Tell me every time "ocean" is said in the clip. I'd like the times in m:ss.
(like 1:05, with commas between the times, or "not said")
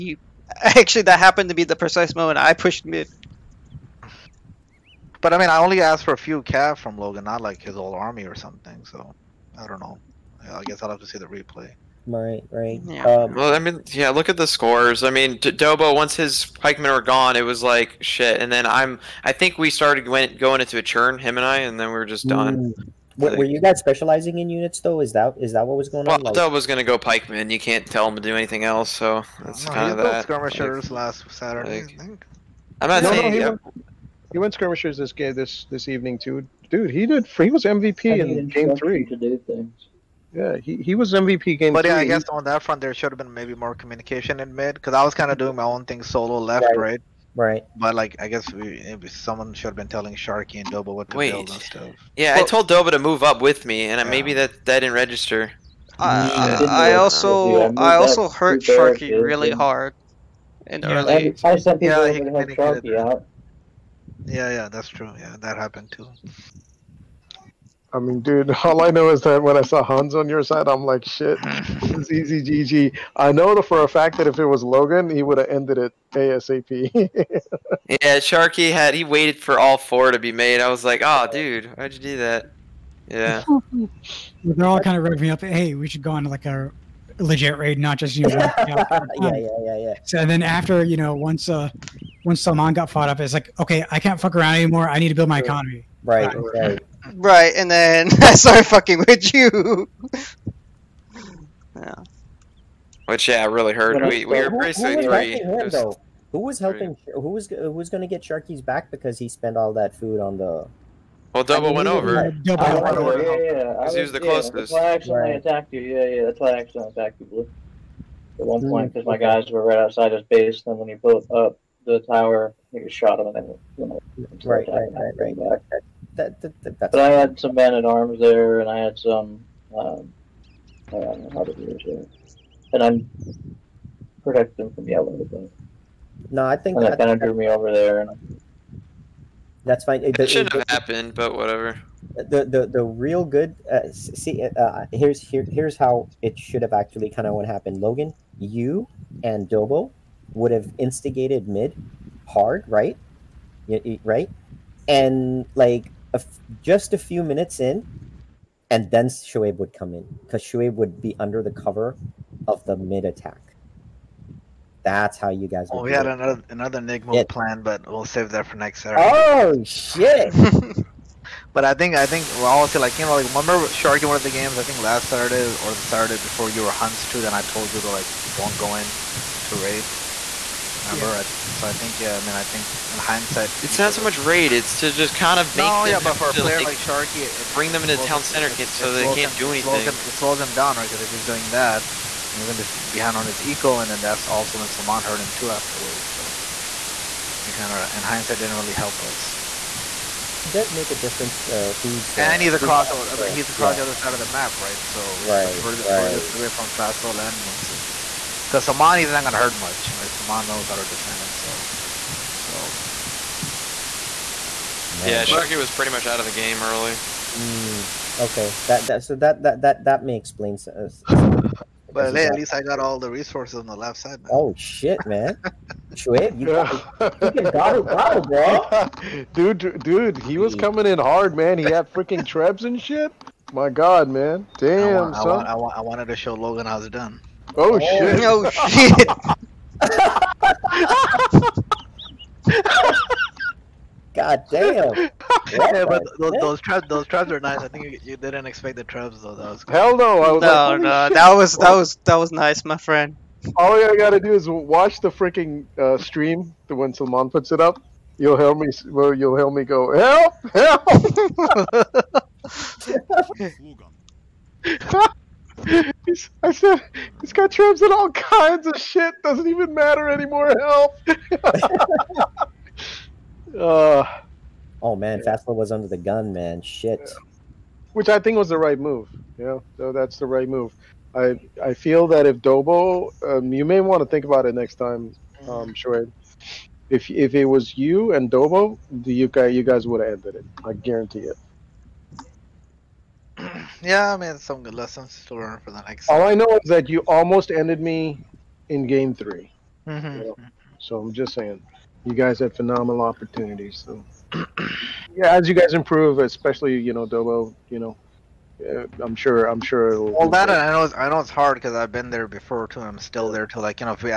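not said.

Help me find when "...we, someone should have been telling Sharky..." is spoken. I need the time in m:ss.
0:48.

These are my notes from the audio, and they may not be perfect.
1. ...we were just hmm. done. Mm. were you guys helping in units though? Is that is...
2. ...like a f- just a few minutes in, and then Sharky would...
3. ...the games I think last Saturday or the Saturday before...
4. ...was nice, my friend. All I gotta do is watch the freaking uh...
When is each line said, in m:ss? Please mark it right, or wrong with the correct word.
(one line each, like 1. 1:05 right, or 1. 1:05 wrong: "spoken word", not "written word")
1. 0:21 wrong: "specializing", not "helping"
2. 2:35 wrong: "Shoaib", not "Sharky"
3. 2:54 right
4. 4:12 right.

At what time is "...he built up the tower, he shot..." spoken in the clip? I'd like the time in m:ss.
2:00.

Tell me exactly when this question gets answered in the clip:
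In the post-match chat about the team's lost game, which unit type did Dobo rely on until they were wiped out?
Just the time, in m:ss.
0:16.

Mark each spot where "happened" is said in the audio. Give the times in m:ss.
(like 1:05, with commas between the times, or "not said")
0:01, 1:05, 2:20, 2:27.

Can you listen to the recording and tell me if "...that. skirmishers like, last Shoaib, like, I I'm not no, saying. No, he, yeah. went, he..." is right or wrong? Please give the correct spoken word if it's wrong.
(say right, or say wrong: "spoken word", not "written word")
wrong: "Saturday", not "Shoaib".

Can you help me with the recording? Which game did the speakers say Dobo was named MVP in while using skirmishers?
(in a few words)
game three.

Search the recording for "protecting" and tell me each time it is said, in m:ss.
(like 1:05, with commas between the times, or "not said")
2:14.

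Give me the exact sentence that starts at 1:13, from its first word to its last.
I know for a fact that if it was Logan, he would have ended it ASAP.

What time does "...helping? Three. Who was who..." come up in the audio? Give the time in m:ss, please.
1:46.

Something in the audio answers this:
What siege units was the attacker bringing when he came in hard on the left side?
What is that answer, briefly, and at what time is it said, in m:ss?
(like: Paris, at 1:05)
trebs, at 3:52.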